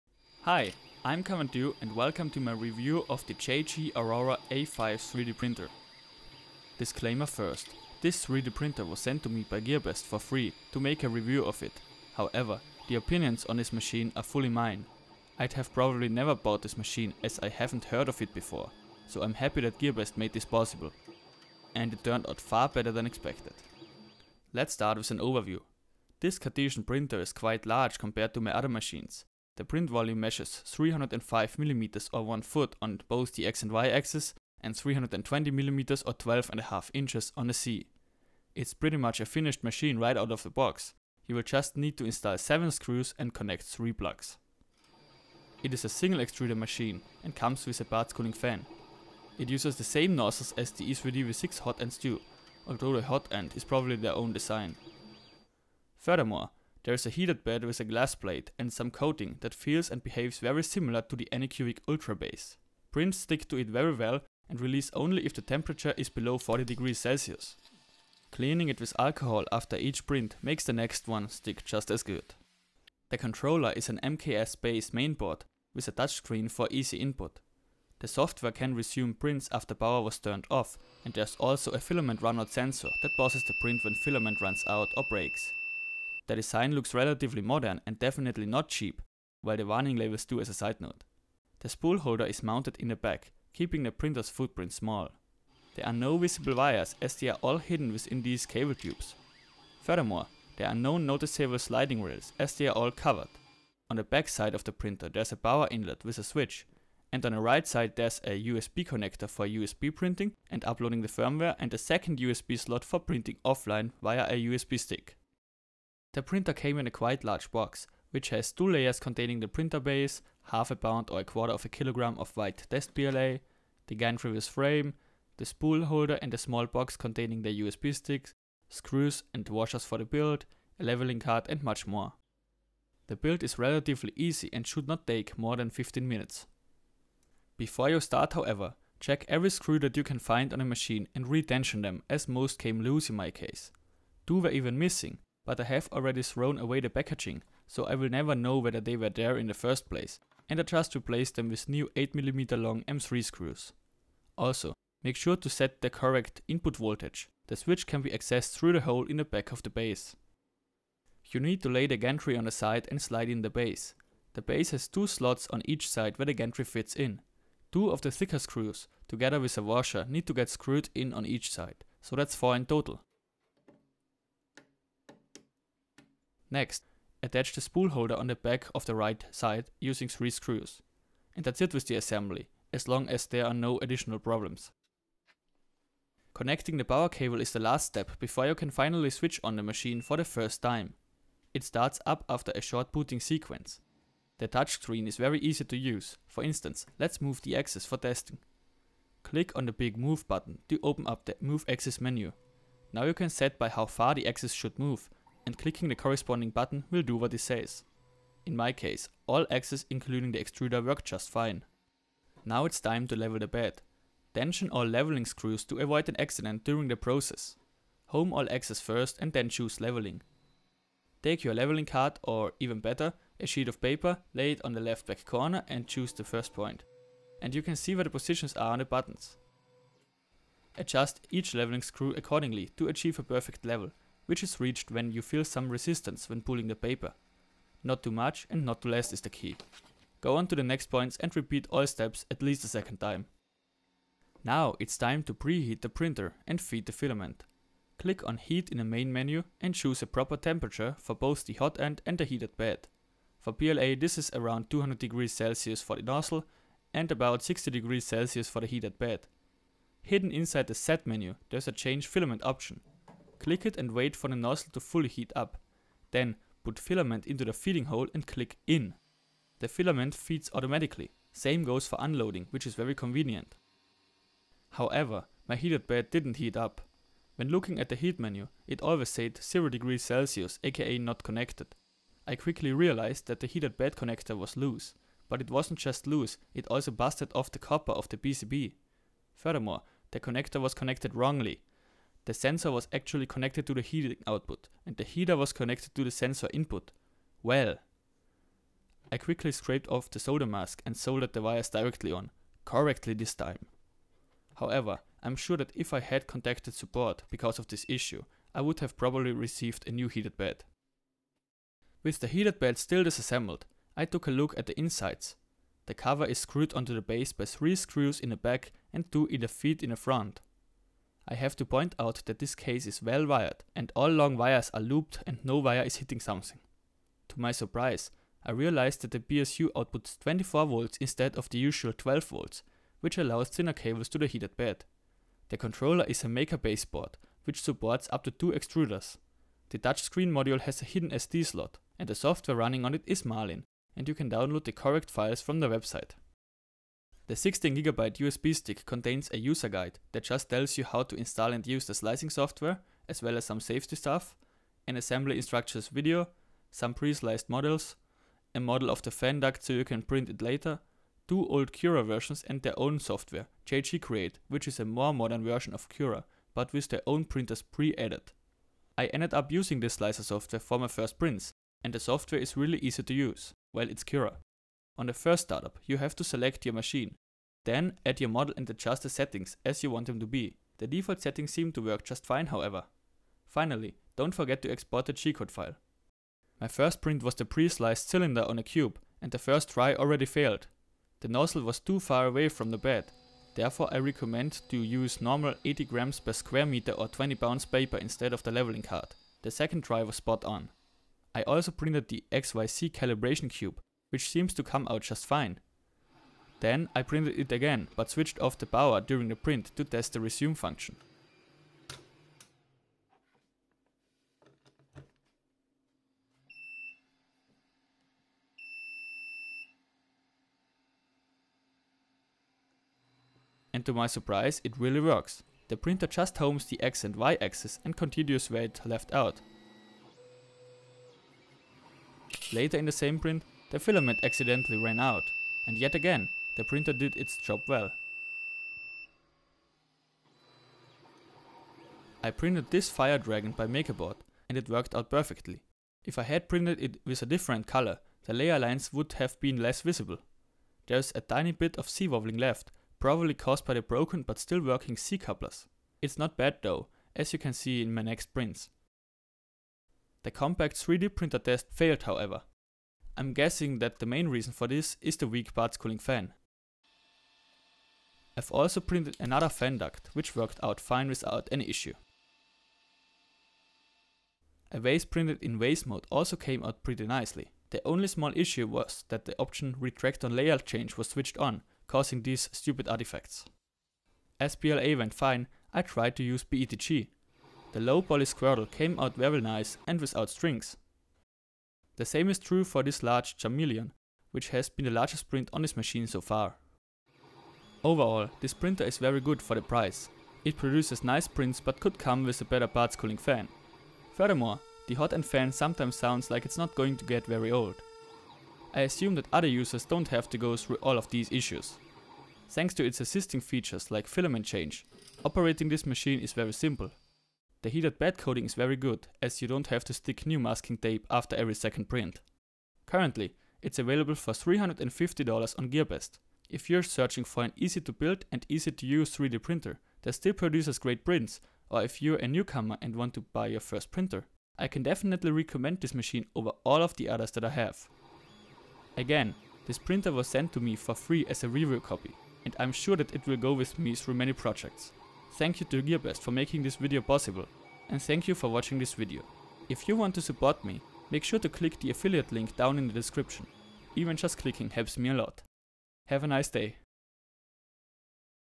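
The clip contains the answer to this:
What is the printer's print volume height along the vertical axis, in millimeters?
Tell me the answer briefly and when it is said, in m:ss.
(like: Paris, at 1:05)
320 mm, at 0:34.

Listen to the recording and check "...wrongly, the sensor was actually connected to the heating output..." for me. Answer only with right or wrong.
right.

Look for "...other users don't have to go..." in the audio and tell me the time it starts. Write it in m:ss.
8:29.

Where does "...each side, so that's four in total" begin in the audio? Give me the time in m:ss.
2:51.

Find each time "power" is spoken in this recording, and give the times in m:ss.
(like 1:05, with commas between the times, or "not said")
1:19, 1:45, 3:06, 6:48.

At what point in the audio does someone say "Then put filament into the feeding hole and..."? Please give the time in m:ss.
4:26.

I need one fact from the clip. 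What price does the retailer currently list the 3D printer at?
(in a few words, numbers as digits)
$350.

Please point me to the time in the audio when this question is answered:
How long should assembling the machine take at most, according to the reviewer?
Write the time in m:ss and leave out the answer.
2:15.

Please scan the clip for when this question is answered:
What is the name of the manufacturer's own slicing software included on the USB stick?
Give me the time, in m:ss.
6:03.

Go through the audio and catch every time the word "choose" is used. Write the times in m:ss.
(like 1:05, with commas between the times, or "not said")
3:39, 3:45, 4:09.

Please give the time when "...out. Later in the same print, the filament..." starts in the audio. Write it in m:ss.
7:09.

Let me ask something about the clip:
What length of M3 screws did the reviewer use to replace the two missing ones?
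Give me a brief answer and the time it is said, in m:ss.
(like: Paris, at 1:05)
8mm, at 2:31.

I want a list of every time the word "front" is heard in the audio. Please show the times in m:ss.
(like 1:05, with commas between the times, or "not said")
5:19.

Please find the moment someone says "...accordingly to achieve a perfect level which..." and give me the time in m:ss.
3:52.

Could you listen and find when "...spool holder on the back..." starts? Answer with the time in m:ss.
2:57.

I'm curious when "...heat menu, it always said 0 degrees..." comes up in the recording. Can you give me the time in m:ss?
4:37.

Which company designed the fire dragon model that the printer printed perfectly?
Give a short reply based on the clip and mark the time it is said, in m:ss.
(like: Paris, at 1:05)
MakerBot, at 7:23.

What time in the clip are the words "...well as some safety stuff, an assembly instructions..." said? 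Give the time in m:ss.
5:53.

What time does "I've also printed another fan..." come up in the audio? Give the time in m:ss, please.
7:48.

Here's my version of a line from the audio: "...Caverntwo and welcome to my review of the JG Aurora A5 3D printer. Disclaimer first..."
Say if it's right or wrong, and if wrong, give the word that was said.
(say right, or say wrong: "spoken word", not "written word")
right.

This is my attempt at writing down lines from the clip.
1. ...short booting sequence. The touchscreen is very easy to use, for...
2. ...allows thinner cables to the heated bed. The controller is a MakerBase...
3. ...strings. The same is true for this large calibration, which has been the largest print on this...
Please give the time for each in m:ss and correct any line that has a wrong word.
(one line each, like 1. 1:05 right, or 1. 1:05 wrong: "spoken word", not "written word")
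1. 3:12 right
2. 5:33 right
3. 8:10 wrong: "chameleon", not "calibration".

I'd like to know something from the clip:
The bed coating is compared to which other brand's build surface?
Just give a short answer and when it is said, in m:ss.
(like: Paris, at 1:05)
Anycubic Ultra base, at 1:01.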